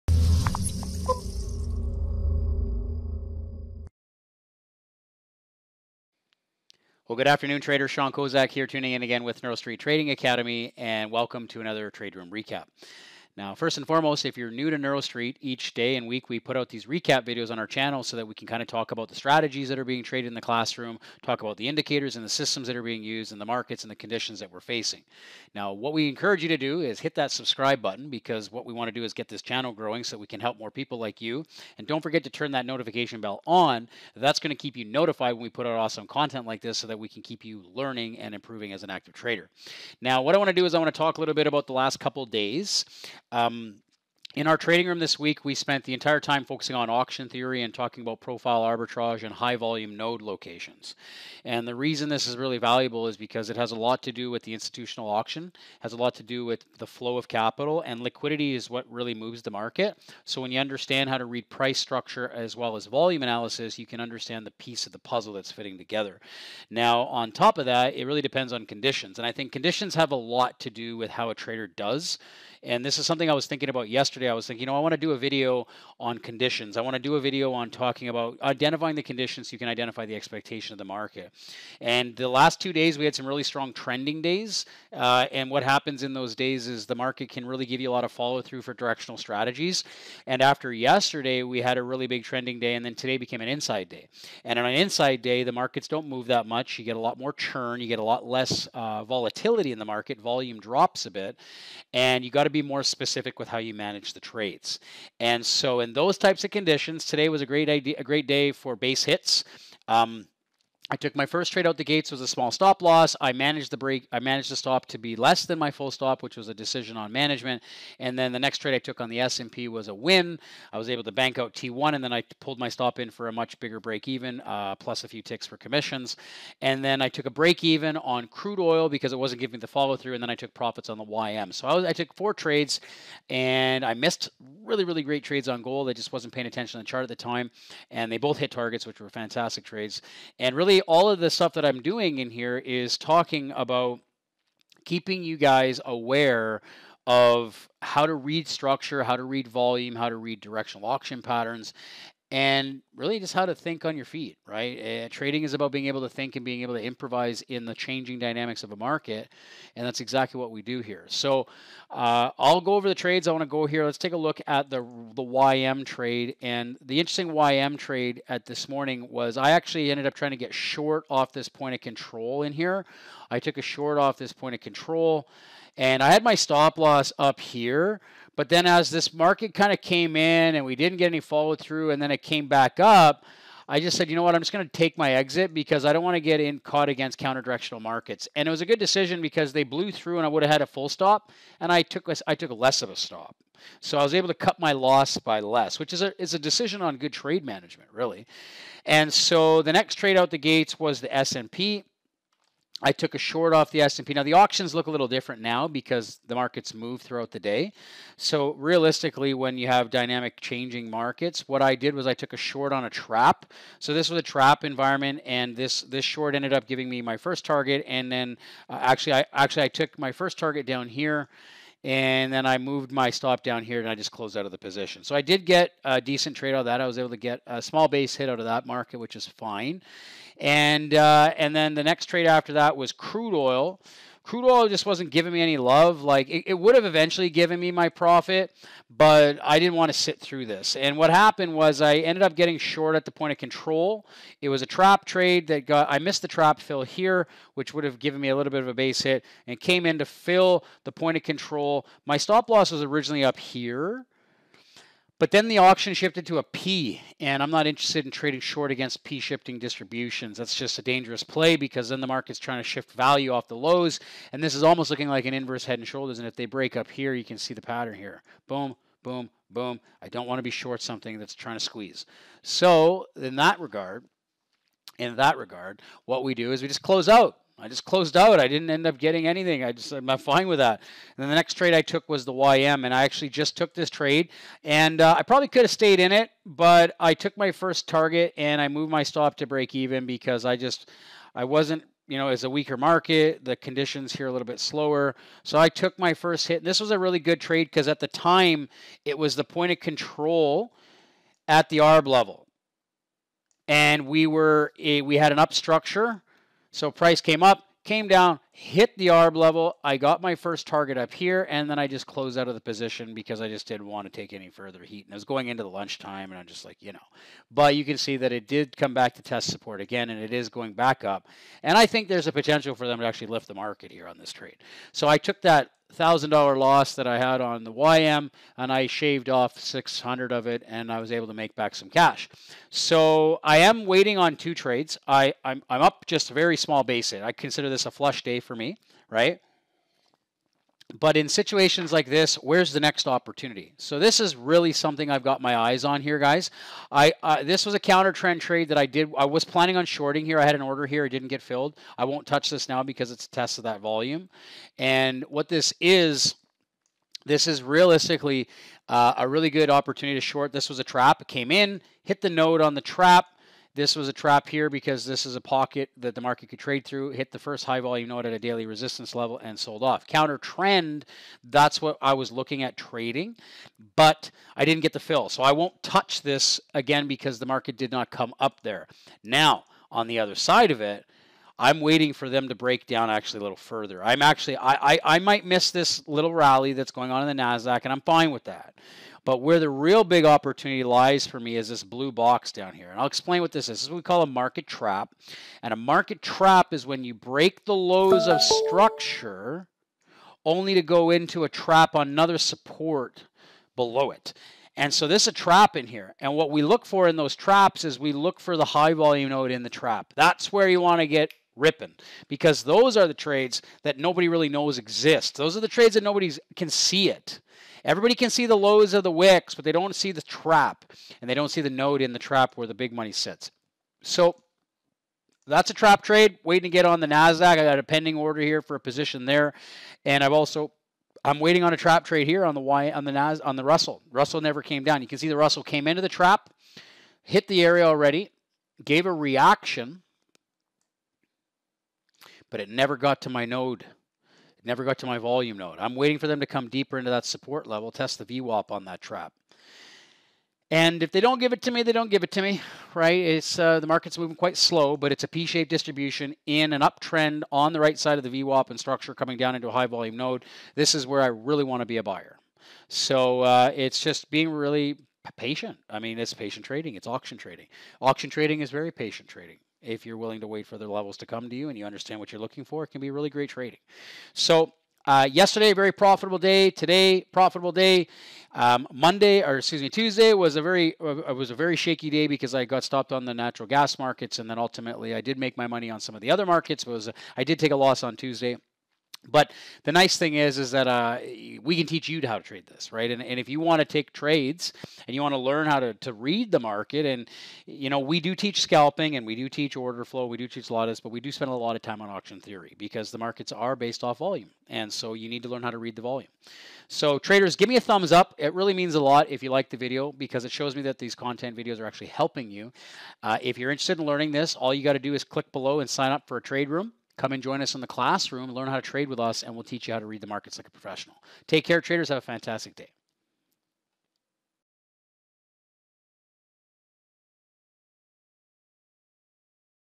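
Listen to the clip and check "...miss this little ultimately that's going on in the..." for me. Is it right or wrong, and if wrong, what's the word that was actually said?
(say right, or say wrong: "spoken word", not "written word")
wrong: "rally", not "ultimately".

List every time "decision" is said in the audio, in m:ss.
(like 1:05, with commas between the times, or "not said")
1:56, 3:08, 3:16.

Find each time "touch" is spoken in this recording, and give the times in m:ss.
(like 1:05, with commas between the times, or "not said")
5:52, 6:15.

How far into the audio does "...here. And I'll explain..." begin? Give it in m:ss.
6:32.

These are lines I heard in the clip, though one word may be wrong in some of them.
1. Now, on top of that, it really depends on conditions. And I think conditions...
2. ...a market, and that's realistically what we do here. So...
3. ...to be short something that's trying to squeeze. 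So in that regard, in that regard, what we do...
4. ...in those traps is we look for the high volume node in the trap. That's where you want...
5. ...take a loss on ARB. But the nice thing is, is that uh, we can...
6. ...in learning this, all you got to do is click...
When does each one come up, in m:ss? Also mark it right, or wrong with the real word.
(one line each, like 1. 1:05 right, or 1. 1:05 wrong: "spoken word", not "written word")
1. 1:06 right
2. 2:38 wrong: "exactly", not "realistically"
3. 4:30 right
4. 6:47 right
5. 8:07 wrong: "Tuesday", not "ARB"
6. 8:33 right.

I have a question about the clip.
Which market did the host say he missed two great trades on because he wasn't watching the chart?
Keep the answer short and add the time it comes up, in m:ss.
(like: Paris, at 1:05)
Gold, at 2:15.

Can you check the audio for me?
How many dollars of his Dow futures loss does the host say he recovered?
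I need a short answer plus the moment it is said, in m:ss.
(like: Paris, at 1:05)
600, at 5:29.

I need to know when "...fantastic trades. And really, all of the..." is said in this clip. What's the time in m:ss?
2:19.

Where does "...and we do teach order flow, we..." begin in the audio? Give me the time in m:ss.
8:19.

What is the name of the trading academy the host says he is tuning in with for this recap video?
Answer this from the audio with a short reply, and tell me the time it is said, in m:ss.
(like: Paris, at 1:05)
NeuroStreet Trading Academy, at 0:09.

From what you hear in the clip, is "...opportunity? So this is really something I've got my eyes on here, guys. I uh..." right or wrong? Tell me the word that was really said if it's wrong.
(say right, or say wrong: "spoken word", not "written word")
right.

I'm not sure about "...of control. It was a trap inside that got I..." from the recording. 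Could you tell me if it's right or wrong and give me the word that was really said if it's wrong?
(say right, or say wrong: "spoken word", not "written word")
wrong: "trade", not "inside".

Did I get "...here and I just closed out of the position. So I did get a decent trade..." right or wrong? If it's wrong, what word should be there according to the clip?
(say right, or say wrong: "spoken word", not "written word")
right.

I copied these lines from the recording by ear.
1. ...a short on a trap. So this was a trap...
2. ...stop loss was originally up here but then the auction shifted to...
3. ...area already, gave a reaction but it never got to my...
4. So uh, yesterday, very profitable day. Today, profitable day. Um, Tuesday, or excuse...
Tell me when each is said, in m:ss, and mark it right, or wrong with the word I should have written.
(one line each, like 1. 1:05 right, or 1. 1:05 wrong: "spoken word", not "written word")
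1. 3:32 right
2. 4:12 right
3. 7:17 right
4. 7:54 wrong: "Monday", not "Tuesday".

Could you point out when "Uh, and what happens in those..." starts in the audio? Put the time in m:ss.
1:24.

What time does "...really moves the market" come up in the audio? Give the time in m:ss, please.
0:58.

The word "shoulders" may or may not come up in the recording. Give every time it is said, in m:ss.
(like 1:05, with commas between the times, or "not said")
4:25.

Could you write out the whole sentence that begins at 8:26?
So traders, give me a thumbs up.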